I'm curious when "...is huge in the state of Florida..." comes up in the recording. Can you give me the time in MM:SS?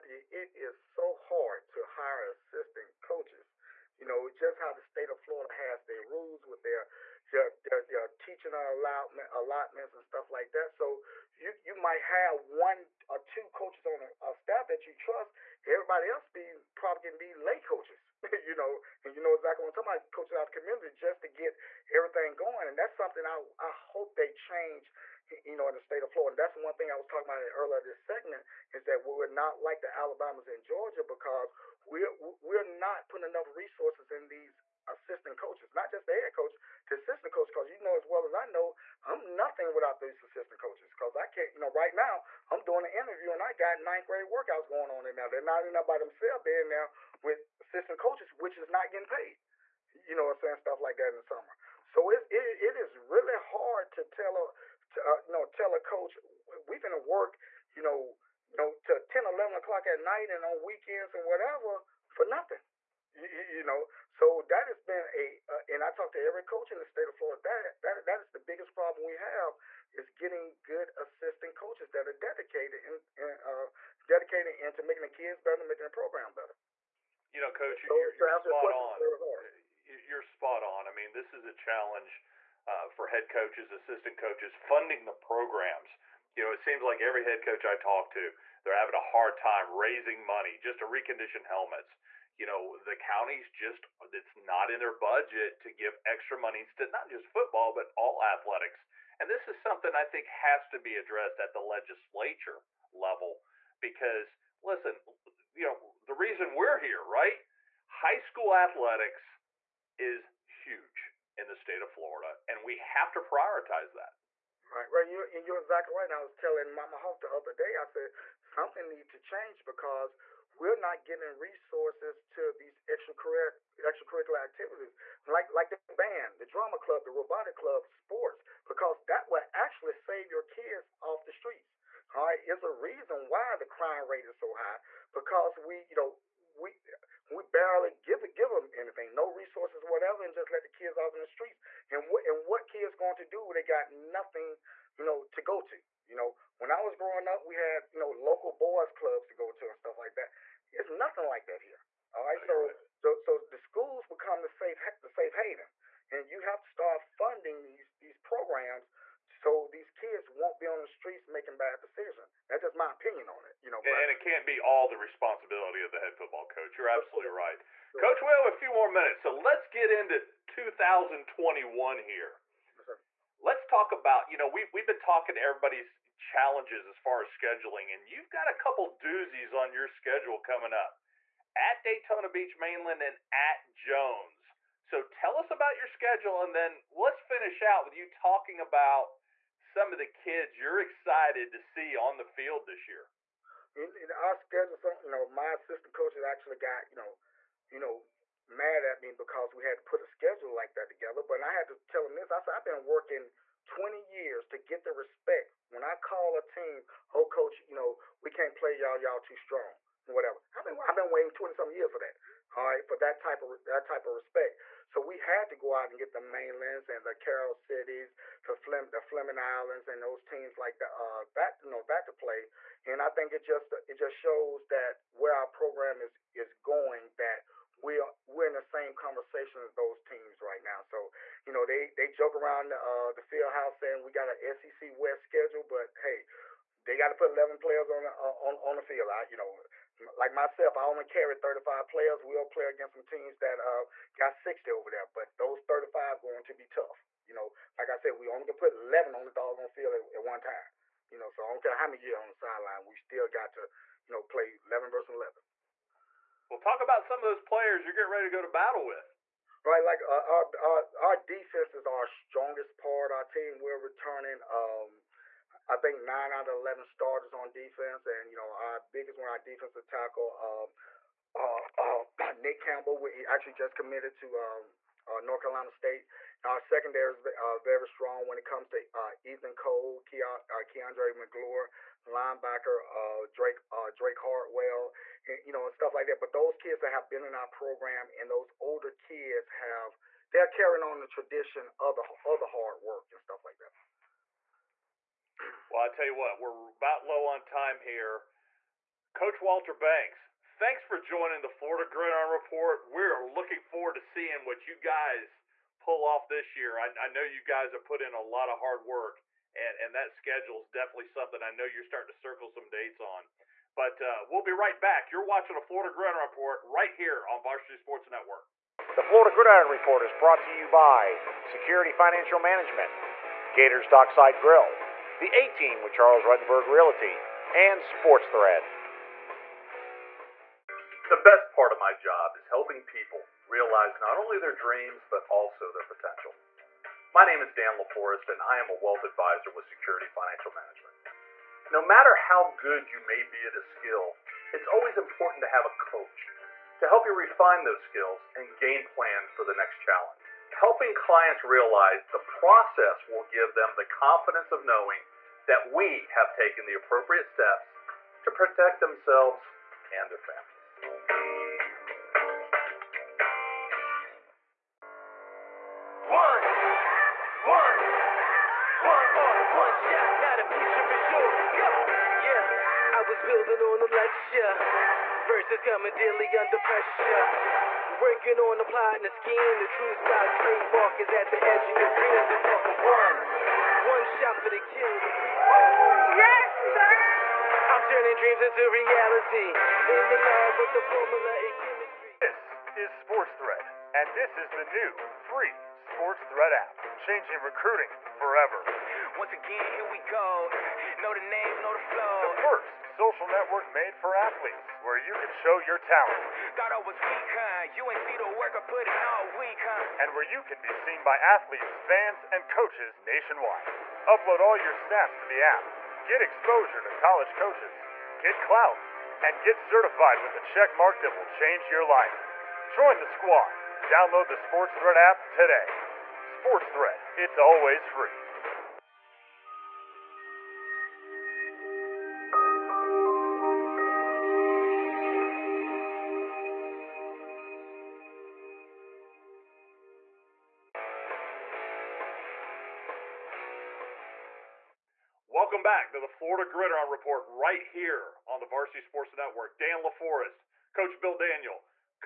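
01:49.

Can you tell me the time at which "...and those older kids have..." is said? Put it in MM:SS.
04:48.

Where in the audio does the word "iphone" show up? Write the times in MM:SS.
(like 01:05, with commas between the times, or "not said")
not said.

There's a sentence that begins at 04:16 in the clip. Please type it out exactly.
Well, talk about some of those players you're getting ready to go to battle with.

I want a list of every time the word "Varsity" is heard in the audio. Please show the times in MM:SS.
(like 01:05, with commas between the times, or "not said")
05:17, 07:28.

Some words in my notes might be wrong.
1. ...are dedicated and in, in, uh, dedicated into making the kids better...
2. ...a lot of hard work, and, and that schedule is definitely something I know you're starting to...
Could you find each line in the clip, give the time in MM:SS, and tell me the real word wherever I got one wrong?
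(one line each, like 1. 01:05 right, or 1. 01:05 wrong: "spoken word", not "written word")
1. 01:12 right
2. 05:08 right.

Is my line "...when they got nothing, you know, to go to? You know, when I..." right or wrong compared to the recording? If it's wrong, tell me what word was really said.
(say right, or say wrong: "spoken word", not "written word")
right.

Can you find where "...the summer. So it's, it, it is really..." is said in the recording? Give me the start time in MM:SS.
00:51.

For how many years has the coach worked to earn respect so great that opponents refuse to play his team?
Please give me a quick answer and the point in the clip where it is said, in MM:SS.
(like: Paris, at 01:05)
20, at 03:23.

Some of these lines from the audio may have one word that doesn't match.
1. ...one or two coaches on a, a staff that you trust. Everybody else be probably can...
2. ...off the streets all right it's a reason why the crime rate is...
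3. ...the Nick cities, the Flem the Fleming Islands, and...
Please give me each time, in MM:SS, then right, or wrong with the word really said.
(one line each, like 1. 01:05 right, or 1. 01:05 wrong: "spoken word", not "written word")
1. 00:12 right
2. 02:11 right
3. 03:37 wrong: "Carol", not "Nick".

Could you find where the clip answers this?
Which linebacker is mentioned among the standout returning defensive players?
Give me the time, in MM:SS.
04:43.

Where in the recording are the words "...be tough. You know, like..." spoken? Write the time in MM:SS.
04:06.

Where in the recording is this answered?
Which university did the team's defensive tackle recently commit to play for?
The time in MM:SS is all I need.
04:35.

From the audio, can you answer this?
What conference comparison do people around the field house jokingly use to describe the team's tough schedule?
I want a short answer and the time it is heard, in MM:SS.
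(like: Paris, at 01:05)
SEC West, at 03:54.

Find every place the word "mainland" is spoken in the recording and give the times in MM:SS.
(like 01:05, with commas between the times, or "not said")
03:02, 03:36.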